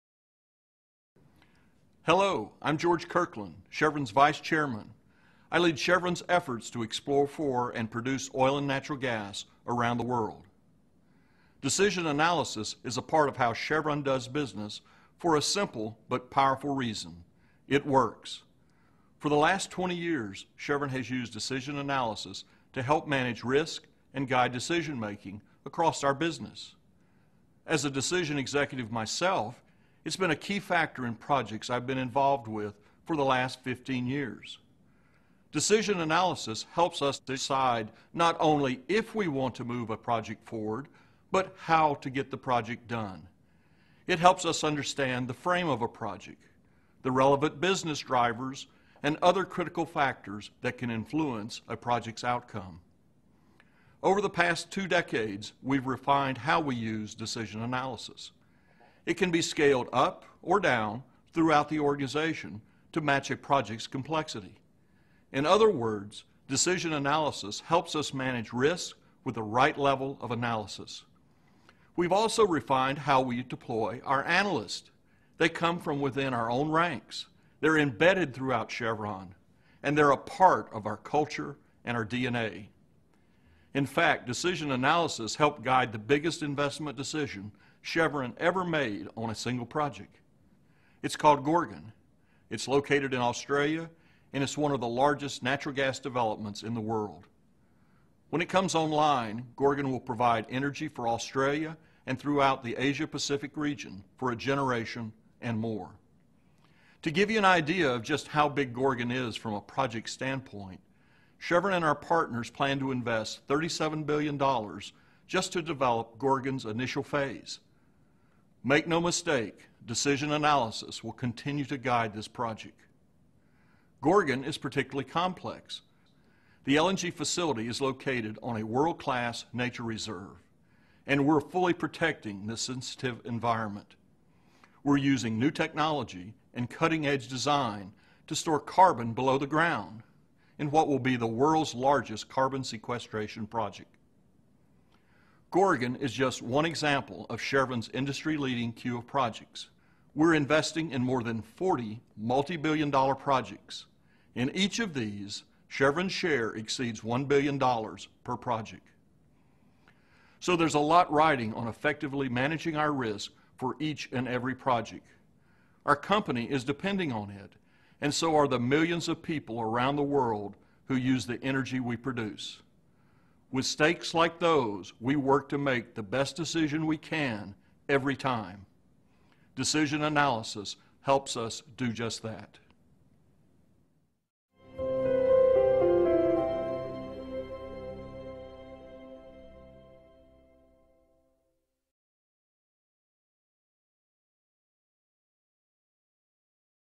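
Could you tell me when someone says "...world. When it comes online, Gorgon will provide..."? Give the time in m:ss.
1:36.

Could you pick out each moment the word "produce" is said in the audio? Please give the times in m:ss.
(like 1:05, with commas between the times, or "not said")
0:07, 2:51.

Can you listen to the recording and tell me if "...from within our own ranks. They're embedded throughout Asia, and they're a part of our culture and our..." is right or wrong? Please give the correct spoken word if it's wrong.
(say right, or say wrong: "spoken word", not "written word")
wrong: "Chevron", not "Asia".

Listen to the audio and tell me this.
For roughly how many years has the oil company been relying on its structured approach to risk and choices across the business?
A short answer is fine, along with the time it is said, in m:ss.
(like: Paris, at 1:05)
20 years, at 0:19.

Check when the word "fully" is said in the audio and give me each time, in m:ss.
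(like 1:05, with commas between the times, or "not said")
2:11.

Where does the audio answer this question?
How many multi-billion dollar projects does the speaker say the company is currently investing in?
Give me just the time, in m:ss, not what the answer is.
2:31.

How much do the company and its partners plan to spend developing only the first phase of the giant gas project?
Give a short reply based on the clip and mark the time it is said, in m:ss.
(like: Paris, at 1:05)
$37 billion, at 1:53.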